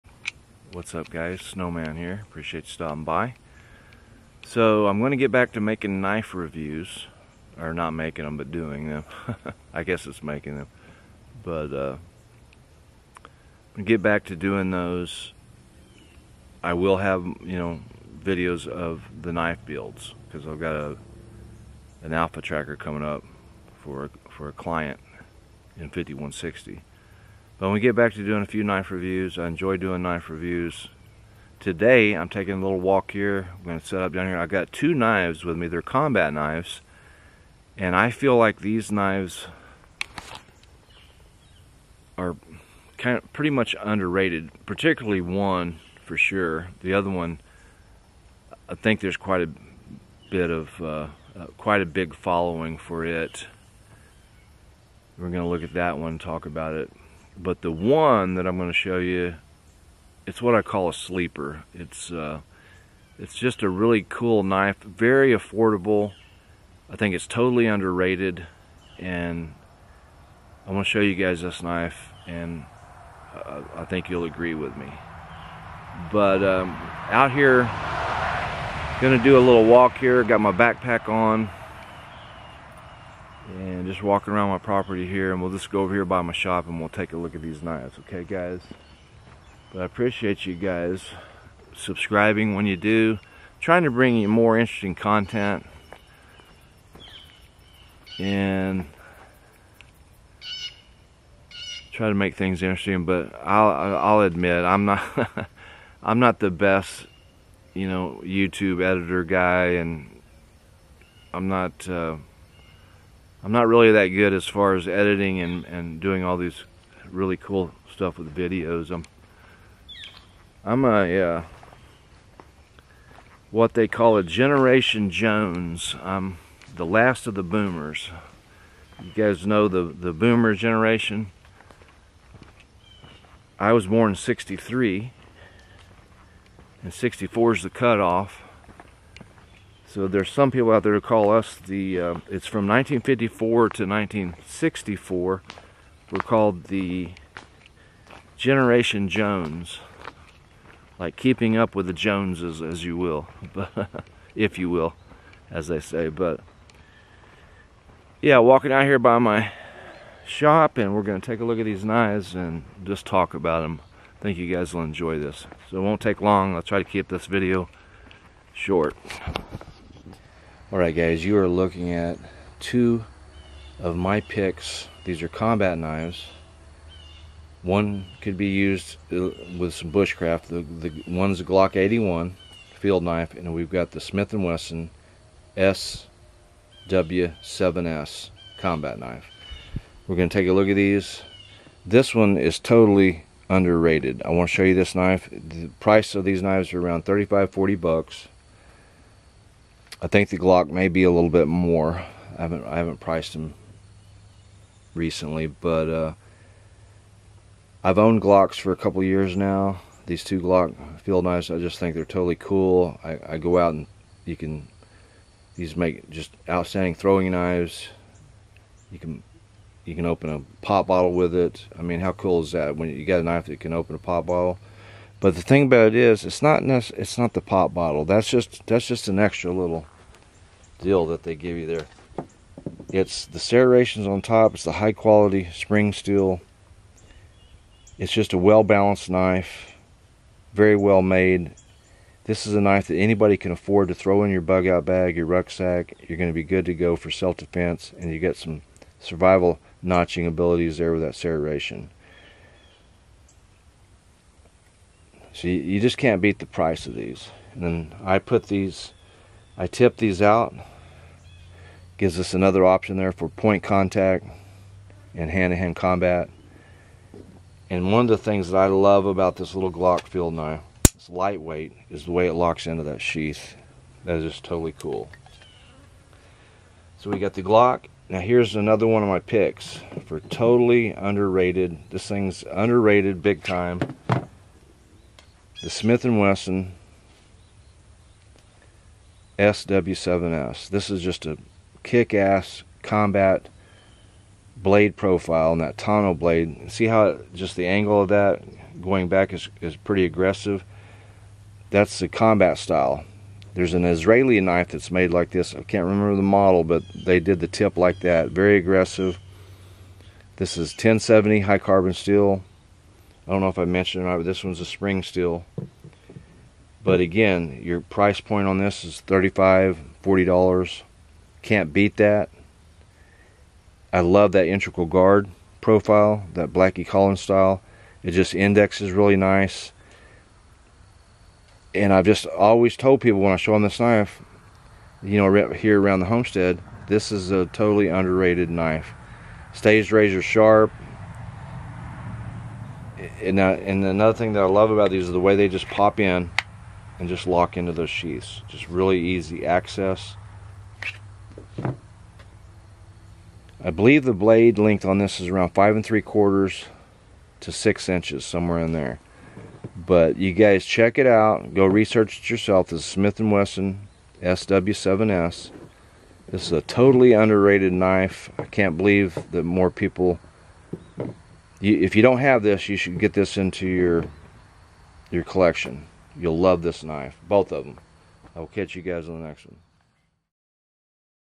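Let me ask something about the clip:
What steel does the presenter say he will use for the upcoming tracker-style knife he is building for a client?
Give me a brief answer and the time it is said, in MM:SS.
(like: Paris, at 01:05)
5160, at 00:25.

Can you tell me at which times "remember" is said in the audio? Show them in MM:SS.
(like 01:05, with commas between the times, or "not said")
05:05.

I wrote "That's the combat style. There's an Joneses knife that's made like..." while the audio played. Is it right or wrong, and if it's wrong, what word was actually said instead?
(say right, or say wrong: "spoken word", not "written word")
wrong: "Israeli", not "Joneses".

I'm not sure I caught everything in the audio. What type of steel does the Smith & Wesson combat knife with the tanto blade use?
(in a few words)
1070 high carbon steel.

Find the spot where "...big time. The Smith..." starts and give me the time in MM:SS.
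04:43.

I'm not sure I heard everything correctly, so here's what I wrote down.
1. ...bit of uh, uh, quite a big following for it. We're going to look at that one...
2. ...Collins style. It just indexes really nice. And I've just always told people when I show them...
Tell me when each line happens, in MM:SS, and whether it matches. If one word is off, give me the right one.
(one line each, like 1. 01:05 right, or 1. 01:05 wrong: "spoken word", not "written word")
1. 00:50 right
2. 05:26 right.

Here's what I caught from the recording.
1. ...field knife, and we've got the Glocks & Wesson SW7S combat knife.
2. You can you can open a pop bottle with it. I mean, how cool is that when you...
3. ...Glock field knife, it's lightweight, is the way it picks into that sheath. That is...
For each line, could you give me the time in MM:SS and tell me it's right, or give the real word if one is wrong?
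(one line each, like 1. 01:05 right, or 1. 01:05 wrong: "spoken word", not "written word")
1. 03:02 wrong: "Smith", not "Glocks"
2. 03:38 right
3. 04:29 wrong: "locks", not "picks".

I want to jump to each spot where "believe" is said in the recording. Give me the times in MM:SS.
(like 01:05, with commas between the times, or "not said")
05:53, 06:08.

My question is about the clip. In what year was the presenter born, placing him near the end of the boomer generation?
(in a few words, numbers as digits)
1963.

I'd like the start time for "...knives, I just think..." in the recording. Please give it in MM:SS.
03:31.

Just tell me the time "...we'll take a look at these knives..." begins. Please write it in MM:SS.
01:26.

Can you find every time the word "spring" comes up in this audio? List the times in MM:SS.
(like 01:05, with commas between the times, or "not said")
03:55, 05:14.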